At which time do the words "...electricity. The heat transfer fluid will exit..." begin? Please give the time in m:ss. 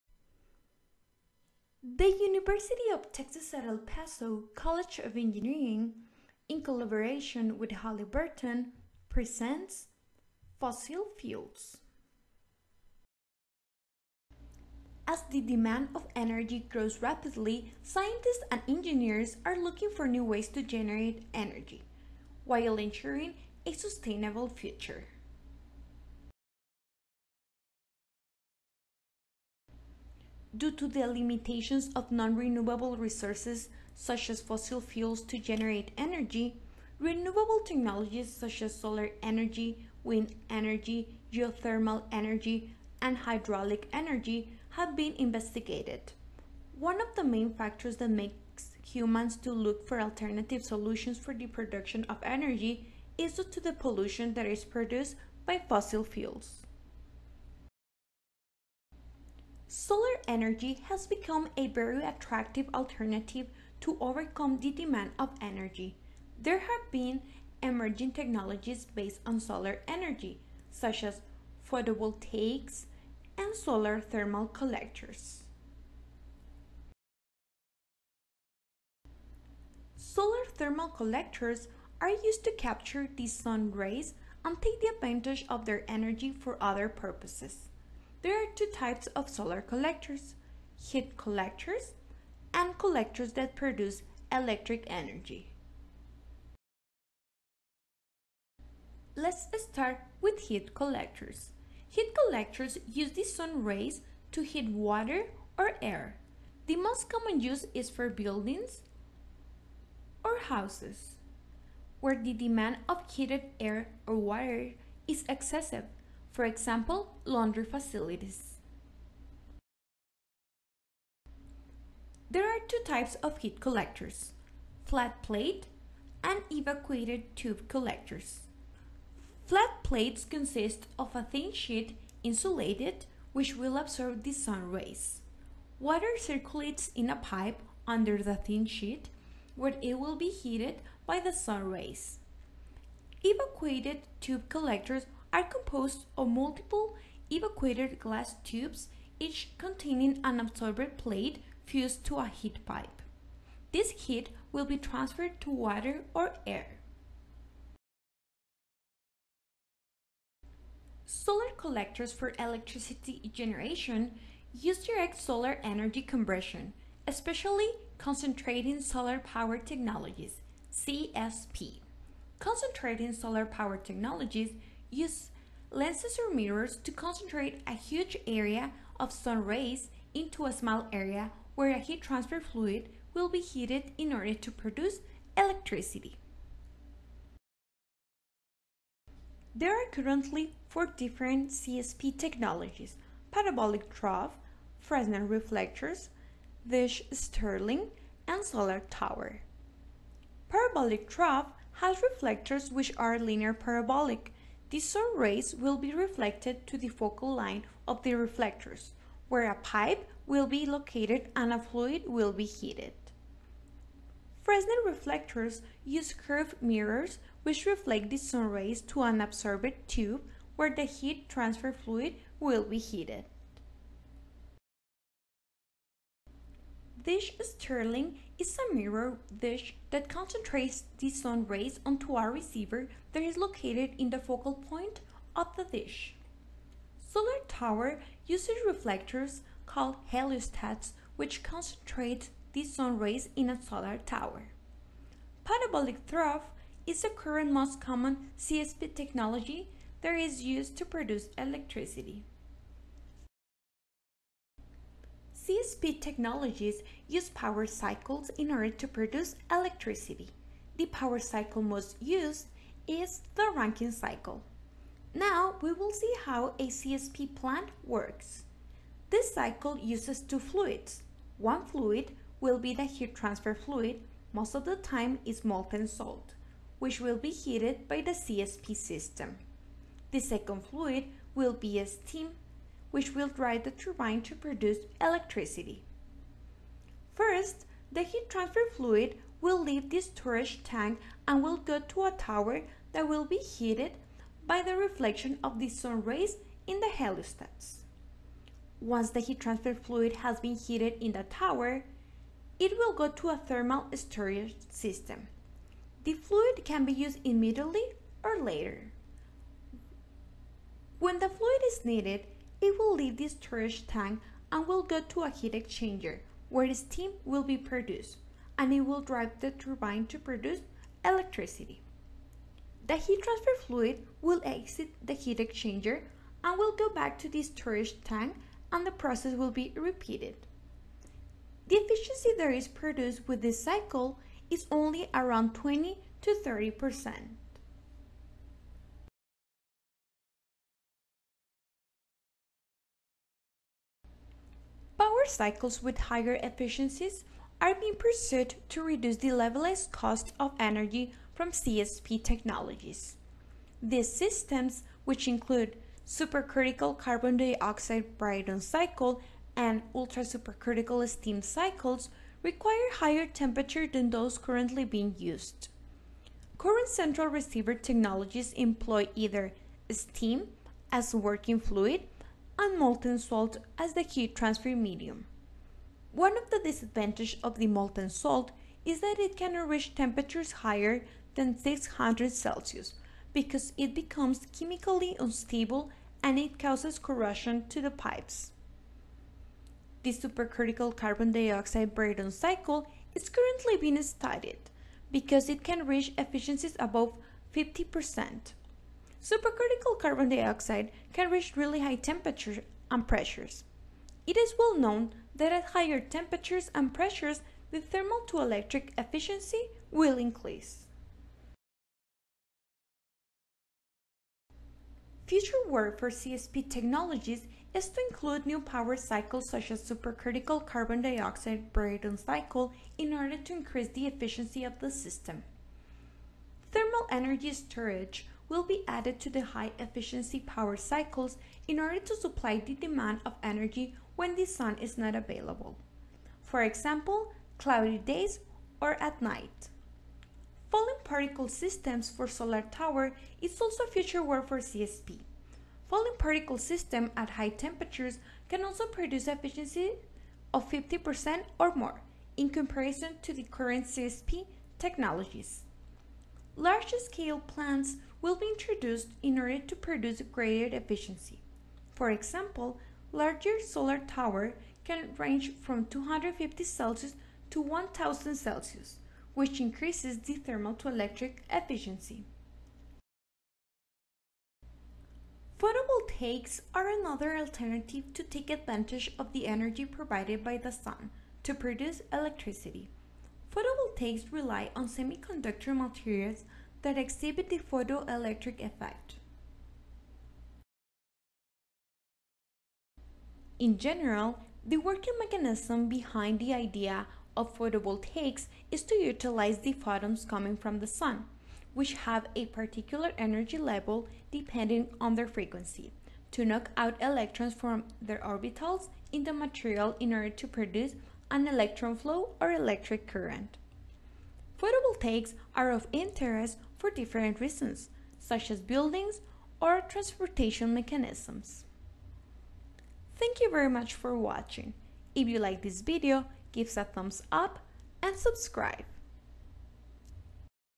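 5:21.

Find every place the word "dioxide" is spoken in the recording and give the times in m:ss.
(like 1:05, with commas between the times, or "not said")
5:57, 6:31, 6:40, 7:01.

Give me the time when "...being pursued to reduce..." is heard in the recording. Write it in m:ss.
5:47.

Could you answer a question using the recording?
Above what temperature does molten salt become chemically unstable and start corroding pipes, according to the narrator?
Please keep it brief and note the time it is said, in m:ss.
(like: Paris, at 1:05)
600 Celsius, at 6:21.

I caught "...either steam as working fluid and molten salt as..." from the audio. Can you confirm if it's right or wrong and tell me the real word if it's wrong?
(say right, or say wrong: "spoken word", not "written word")
right.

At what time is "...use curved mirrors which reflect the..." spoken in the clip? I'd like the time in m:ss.
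3:35.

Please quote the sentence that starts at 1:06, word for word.
There have been emerging technologies based on solar energy, such as photovoltaics and solar thermal collectors.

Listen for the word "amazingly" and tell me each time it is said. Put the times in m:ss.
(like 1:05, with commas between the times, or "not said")
not said.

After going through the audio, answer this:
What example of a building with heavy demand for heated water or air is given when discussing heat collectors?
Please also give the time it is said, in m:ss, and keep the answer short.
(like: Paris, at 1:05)
laundry facilities, at 1:57.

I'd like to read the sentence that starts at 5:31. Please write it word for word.
The efficiency that is produced with this cycle is only around 20 to 30 percent.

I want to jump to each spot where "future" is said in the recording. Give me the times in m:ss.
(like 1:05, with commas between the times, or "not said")
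0:24, 6:55, 7:23.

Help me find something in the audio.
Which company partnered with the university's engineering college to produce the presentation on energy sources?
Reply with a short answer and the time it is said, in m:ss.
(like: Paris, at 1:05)
Halliburton, at 0:07.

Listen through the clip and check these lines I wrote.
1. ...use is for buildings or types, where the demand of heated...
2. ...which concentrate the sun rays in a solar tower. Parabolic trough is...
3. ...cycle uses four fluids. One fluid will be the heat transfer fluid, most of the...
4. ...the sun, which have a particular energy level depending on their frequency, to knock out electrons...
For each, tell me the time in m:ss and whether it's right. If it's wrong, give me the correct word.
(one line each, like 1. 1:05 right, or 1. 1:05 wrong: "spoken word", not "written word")
1. 1:47 wrong: "houses", not "types"
2. 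4:01 right
3. 4:29 wrong: "two", not "four"
4. 8:20 right.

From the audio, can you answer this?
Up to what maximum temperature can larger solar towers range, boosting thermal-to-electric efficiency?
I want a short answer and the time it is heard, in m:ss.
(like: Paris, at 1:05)
1000 Celsius, at 7:47.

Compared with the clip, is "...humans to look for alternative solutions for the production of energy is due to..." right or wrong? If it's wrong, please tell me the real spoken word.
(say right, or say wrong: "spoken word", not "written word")
right.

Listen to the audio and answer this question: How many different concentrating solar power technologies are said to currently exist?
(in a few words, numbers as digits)
4.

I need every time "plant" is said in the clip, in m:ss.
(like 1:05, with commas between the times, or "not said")
4:27, 7:37.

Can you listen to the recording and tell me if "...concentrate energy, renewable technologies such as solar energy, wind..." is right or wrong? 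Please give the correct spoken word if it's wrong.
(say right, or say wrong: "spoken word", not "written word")
wrong: "generate", not "concentrate".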